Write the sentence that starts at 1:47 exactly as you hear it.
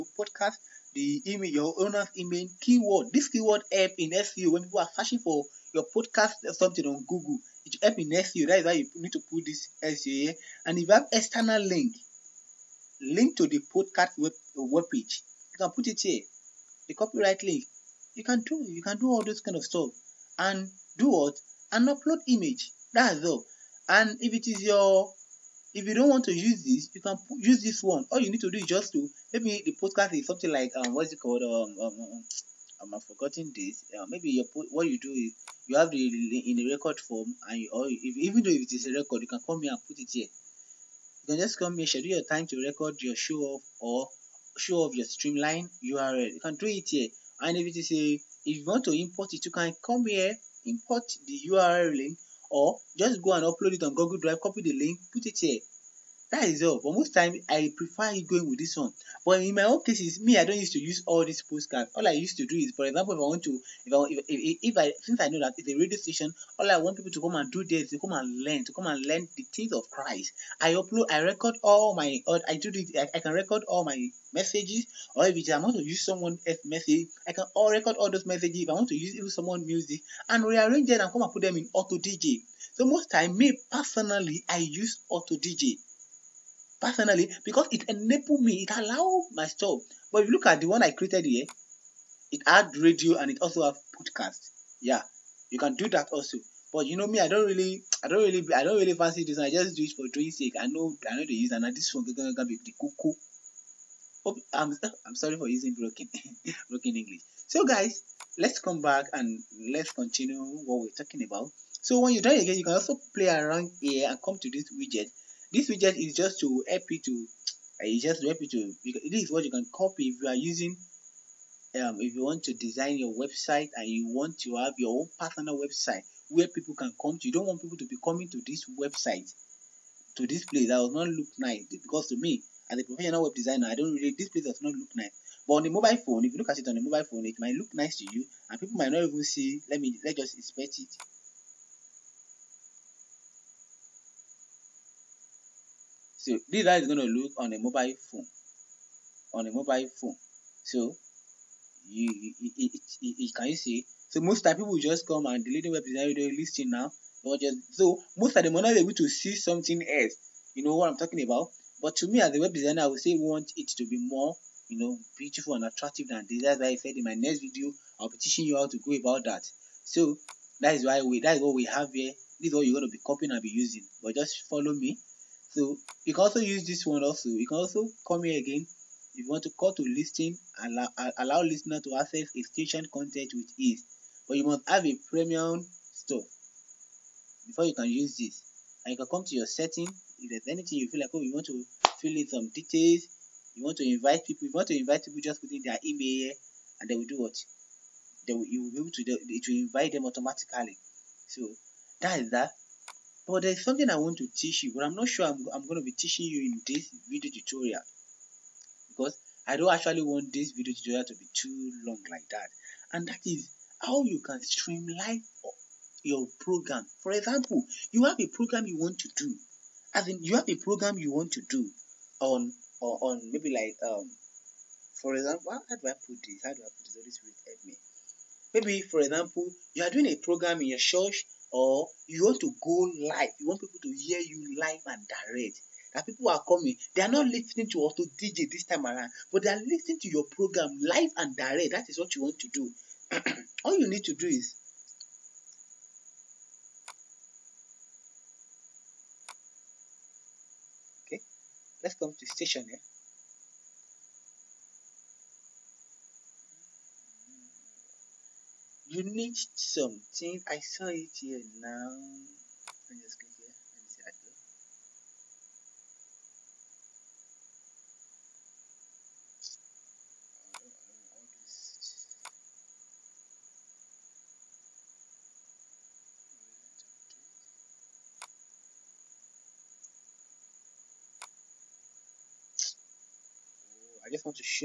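So guys, let's come back and let's continue what we're talking about.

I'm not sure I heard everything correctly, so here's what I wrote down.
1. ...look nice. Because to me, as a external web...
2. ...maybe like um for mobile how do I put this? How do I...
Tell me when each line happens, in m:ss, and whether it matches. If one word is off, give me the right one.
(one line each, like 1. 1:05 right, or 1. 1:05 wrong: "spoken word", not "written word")
1. 2:11 wrong: "professional", not "external"
2. 3:43 wrong: "example", not "mobile".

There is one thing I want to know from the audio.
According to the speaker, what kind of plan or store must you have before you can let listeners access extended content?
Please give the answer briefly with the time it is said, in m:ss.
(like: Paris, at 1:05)
premium, at 3:05.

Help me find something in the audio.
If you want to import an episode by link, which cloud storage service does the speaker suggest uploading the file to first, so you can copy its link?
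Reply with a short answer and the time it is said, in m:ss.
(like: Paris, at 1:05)
Google Drive, at 0:53.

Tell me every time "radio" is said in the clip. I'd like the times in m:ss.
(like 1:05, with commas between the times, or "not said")
1:05, 1:32.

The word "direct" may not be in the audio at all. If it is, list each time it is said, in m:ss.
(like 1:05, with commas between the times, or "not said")
3:55, 4:01.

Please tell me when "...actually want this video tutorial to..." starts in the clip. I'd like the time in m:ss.
3:29.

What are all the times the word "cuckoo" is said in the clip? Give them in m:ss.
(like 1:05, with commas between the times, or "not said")
1:42.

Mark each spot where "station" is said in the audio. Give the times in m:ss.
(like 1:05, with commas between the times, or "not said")
1:05, 4:12.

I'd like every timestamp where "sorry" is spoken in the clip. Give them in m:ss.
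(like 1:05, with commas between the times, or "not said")
1:45.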